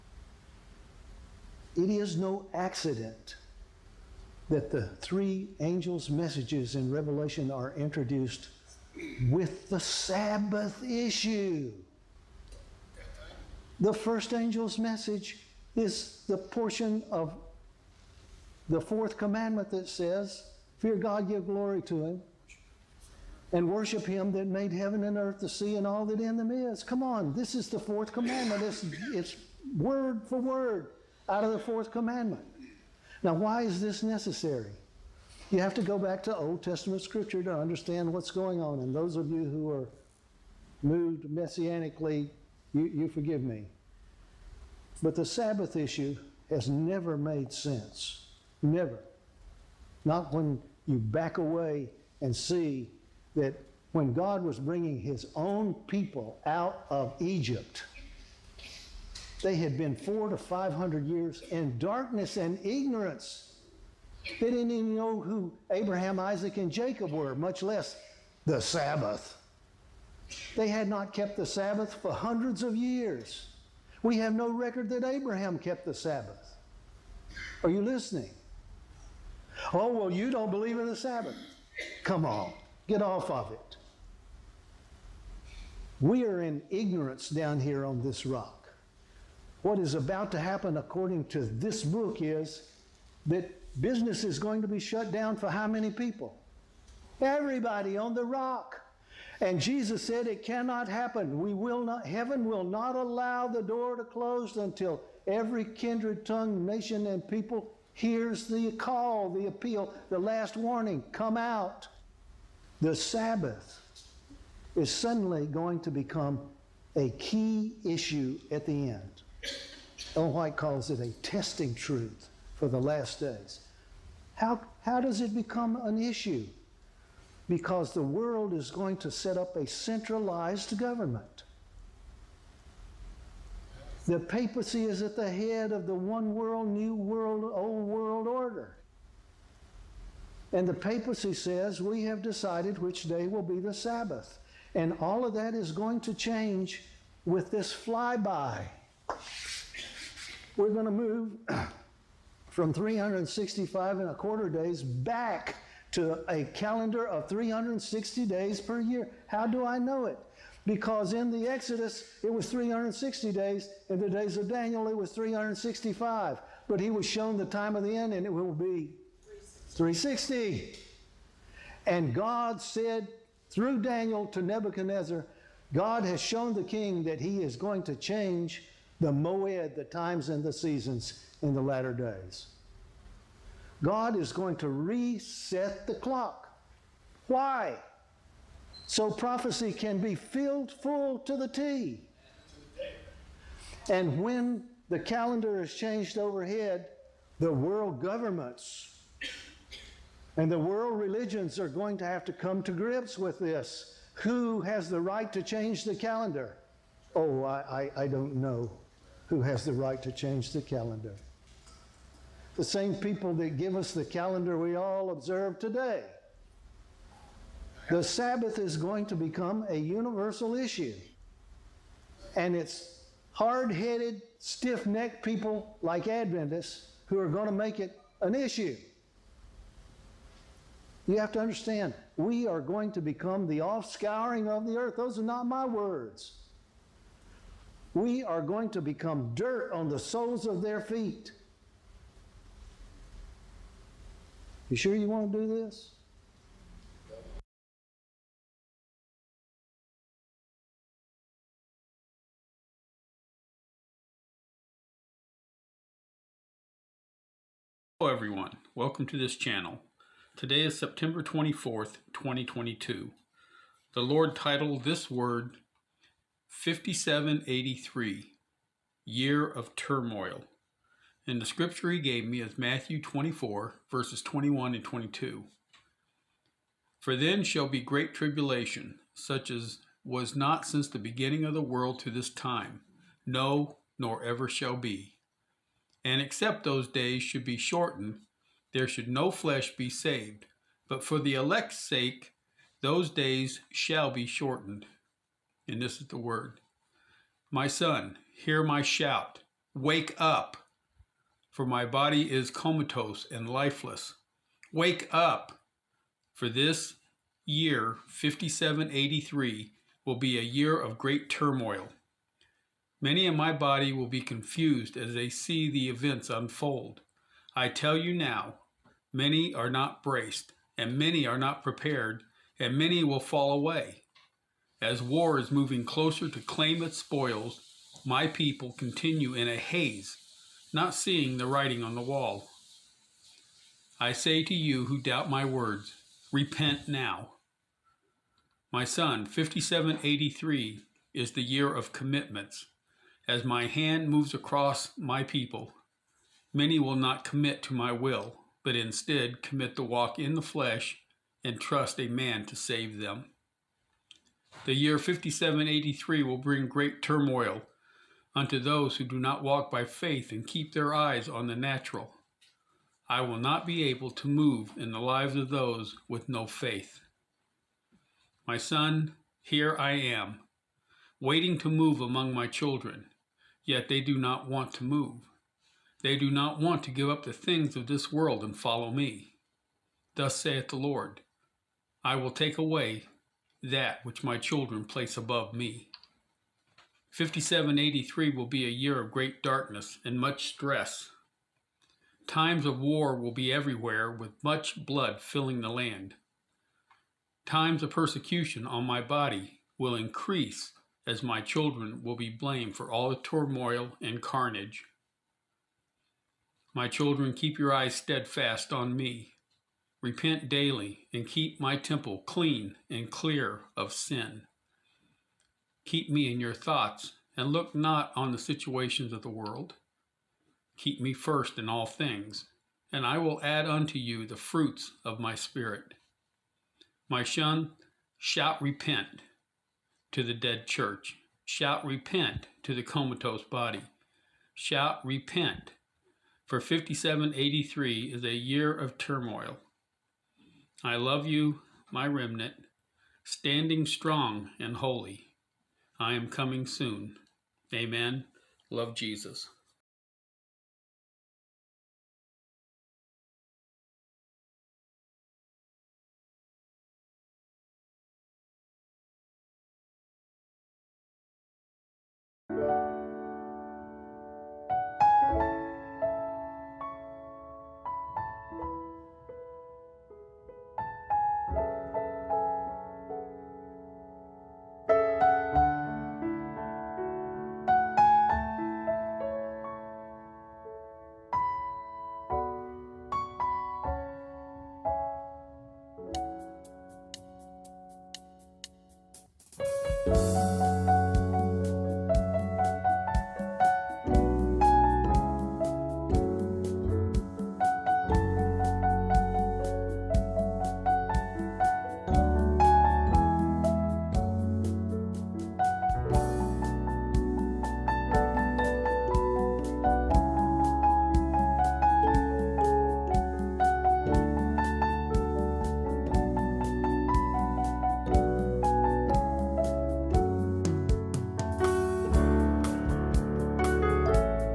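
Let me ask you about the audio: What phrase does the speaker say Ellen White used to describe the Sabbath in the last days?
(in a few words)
testing truth.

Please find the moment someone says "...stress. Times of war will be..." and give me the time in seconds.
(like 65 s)
390 s.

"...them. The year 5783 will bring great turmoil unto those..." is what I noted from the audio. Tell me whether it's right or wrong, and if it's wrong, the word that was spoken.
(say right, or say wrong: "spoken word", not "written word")
right.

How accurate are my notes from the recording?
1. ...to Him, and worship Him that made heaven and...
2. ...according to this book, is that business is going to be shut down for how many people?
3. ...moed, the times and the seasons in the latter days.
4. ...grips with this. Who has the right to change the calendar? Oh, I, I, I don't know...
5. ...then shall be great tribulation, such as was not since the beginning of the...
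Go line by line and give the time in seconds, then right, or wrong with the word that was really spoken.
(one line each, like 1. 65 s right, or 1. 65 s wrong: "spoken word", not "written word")
1. 21 s right
2. 90 s right
3. 179 s right
4. 202 s right
5. 277 s right.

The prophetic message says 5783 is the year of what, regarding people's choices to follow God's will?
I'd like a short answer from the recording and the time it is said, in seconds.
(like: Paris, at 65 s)
commitments, at 341 s.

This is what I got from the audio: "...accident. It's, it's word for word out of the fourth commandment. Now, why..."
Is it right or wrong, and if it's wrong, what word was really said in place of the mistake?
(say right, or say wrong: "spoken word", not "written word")
wrong: "commandment", not "accident".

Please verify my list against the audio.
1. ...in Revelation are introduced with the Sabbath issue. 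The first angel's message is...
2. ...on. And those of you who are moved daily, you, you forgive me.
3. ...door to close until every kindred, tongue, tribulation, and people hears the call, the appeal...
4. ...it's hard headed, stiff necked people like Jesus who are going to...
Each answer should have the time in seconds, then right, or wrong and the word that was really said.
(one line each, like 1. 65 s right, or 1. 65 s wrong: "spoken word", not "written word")
1. 6 s right
2. 38 s wrong: "messianically", not "daily"
3. 103 s wrong: "nation", not "tribulation"
4. 222 s wrong: "Adventists", not "Jesus".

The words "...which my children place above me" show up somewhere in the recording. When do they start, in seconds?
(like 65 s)
384 s.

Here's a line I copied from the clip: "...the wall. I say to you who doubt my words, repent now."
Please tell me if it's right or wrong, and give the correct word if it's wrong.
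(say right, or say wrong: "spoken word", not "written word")
right.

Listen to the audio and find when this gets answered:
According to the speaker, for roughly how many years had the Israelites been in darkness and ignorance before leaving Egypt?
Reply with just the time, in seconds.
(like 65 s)
59 s.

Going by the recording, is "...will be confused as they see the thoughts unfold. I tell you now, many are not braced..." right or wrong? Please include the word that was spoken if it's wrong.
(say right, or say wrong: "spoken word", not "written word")
wrong: "events", not "thoughts".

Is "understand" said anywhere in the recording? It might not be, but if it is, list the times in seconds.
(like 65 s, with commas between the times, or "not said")
37 s, 231 s.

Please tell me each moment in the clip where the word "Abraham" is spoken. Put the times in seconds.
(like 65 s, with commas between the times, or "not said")
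65 s, 75 s.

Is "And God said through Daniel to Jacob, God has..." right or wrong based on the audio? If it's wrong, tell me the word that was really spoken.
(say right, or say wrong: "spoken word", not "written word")
wrong: "Nebuchadnezzar", not "Jacob".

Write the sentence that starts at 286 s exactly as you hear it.
And except those days should be shortened, there should no flesh be saved.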